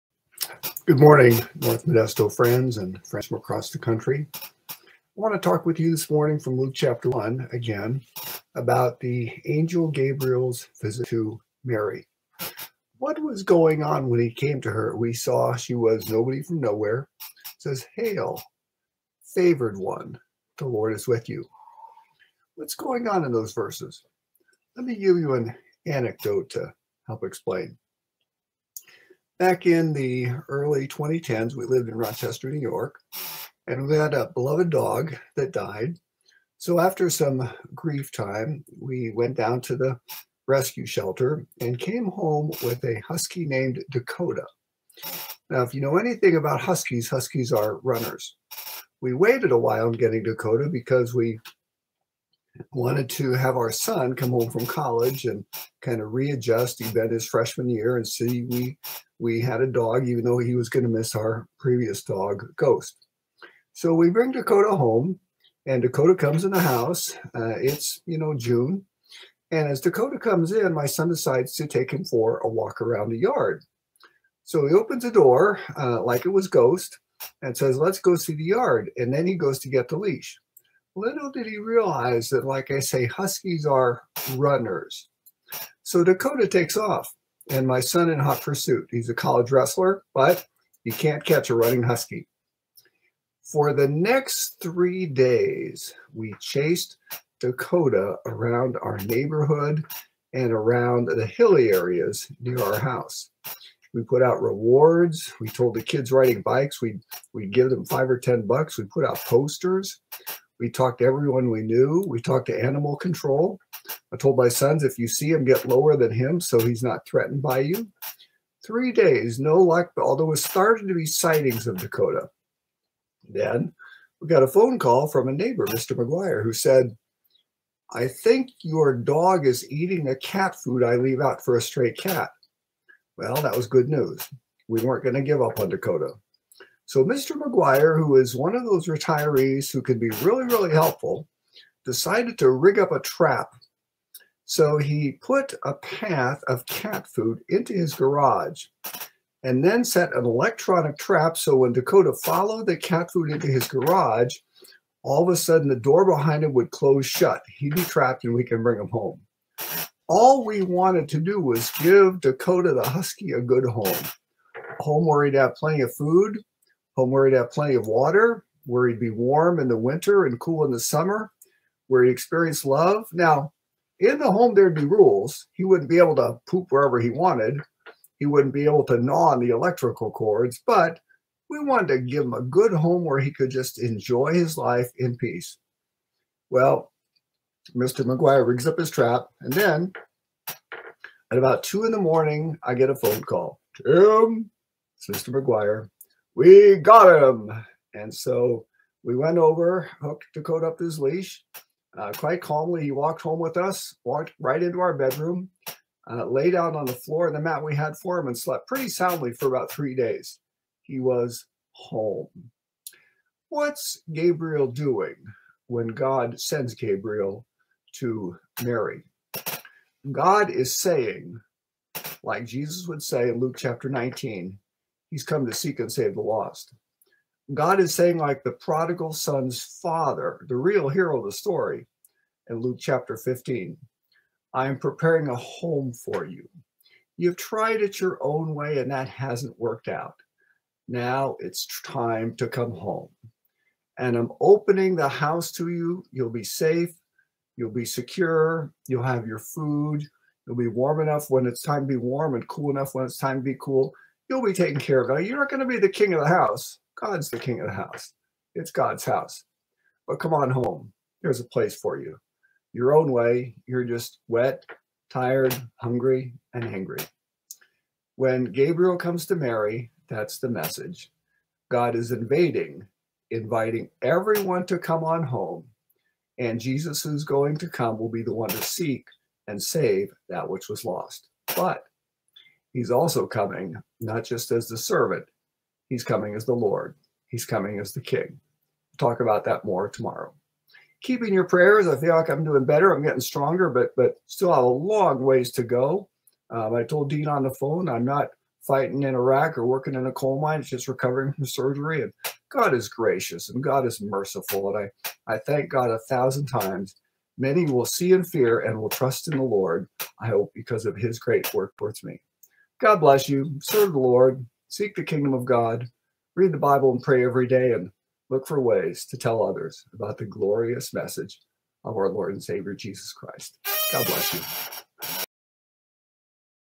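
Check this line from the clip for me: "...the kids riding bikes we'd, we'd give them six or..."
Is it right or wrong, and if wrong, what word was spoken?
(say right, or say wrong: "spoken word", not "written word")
wrong: "five", not "six".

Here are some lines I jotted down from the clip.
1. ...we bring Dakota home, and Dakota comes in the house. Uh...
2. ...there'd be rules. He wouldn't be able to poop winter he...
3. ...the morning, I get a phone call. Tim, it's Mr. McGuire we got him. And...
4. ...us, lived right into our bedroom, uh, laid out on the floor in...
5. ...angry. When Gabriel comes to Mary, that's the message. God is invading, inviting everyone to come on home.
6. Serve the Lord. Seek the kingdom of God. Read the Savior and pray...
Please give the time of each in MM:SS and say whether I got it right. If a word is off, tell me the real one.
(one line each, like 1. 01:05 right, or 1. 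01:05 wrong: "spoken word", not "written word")
1. 01:03 right
2. 02:54 wrong: "wherever", not "winter"
3. 03:11 right
4. 03:23 wrong: "walked", not "lived"
5. 04:26 right
6. 05:13 wrong: "Bible", not "Savior".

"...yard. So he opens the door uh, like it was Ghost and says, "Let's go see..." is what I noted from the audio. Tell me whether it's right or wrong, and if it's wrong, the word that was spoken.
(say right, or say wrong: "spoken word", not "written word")
right.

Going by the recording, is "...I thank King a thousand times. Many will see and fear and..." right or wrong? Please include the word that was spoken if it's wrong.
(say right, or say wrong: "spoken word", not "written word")
wrong: "God", not "King".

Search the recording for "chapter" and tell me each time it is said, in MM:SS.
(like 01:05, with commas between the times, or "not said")
00:06, 03:43, 03:52.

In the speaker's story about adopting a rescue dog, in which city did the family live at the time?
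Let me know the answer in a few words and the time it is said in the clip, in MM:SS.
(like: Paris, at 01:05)
Rochester, New York, at 00:31.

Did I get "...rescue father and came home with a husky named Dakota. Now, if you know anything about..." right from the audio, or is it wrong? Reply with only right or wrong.
wrong.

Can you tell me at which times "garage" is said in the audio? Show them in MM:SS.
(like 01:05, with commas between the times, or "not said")
02:27, 02:33.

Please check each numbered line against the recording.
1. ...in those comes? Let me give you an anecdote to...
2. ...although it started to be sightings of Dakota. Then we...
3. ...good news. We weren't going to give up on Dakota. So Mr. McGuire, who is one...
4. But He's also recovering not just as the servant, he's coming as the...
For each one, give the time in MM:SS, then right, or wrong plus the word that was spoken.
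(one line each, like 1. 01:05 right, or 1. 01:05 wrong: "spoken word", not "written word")
1. 00:23 wrong: "verses", not "comes"
2. 01:59 right
3. 02:13 right
4. 04:41 wrong: "coming", not "recovering".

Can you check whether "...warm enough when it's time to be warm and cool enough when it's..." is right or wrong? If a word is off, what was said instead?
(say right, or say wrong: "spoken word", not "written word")
right.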